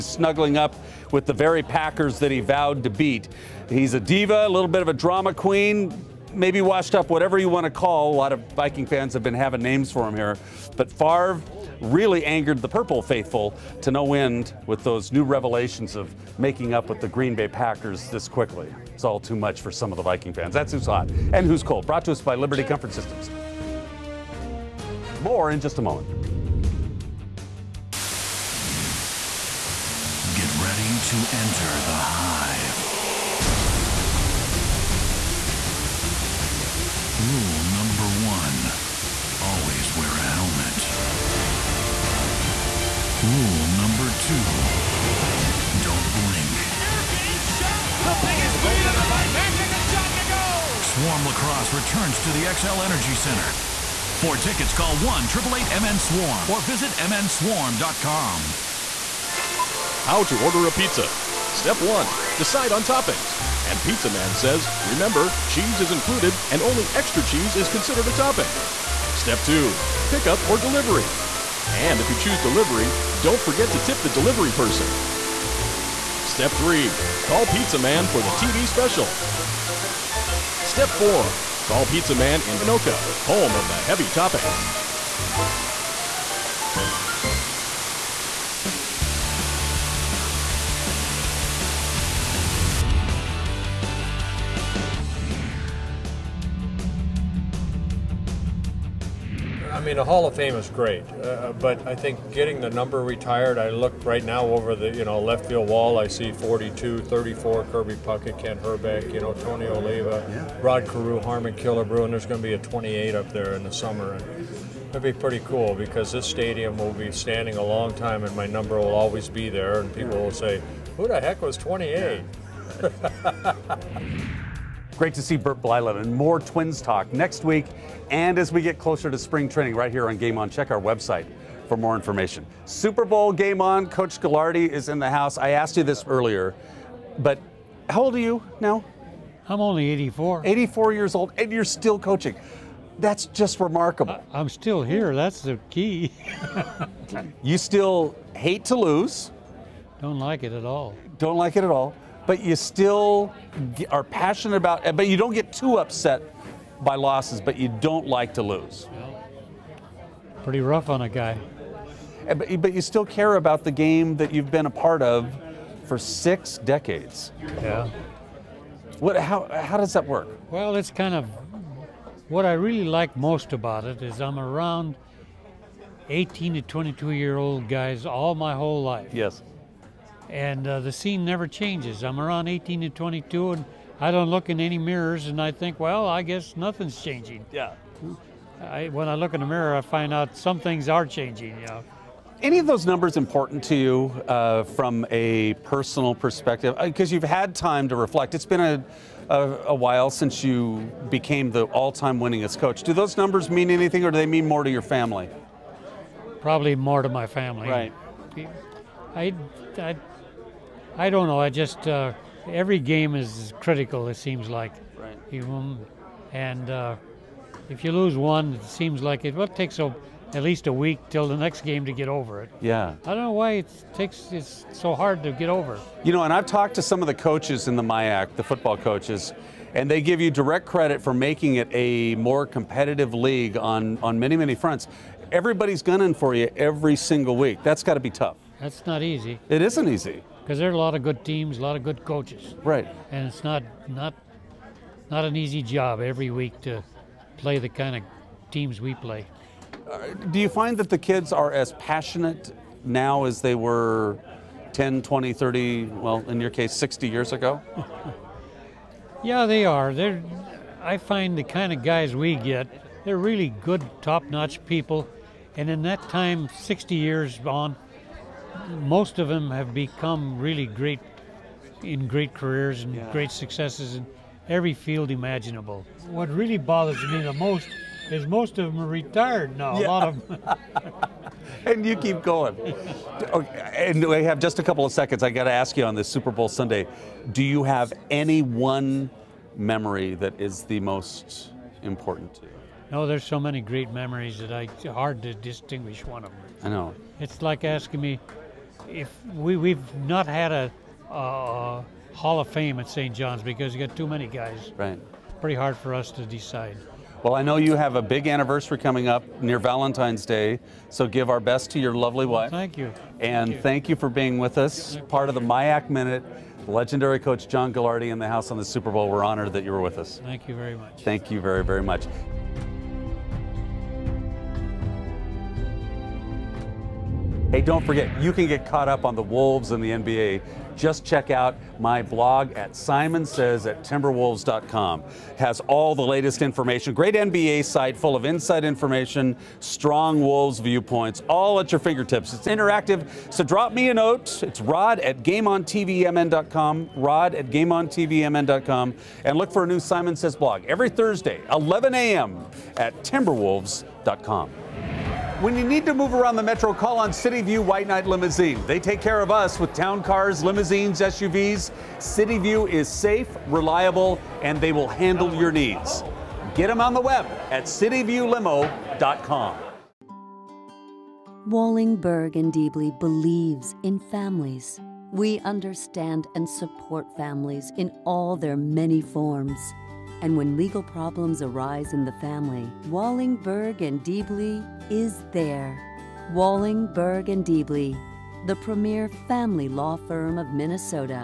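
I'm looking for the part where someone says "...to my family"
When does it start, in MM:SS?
03:27.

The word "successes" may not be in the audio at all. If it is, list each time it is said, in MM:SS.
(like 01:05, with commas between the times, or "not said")
04:33.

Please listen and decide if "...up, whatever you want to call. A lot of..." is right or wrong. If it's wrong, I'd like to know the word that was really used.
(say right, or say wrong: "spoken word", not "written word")
right.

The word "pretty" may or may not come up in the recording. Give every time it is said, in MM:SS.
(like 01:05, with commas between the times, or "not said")
01:55, 02:40, 05:05.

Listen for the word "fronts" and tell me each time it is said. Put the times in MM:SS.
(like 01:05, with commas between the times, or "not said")
03:54.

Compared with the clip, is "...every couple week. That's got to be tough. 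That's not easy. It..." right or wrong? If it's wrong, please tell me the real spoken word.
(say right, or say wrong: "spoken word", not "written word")
wrong: "single", not "couple".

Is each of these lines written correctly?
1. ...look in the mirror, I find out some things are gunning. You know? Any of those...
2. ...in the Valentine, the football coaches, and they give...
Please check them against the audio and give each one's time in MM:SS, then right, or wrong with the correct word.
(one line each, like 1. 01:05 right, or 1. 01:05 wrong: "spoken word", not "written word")
1. 03:09 wrong: "changing", not "gunning"
2. 03:47 wrong: "MIAC", not "Valentine".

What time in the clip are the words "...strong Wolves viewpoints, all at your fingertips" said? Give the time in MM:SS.
05:39.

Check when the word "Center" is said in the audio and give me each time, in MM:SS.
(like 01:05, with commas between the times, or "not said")
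00:53.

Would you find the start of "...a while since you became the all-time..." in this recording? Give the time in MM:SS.
03:19.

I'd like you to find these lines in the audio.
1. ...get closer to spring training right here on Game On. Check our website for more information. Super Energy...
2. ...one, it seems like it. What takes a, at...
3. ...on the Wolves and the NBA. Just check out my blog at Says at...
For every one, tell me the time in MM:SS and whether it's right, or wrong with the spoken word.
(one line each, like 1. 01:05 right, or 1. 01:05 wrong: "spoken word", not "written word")
1. 02:08 wrong: "Bowl", not "Energy"
2. 03:38 right
3. 05:29 right.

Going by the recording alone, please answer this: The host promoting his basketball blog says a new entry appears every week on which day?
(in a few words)
Thursday.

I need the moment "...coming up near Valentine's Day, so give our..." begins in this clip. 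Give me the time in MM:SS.
05:08.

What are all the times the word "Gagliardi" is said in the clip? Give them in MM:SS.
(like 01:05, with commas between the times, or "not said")
02:14, 05:17.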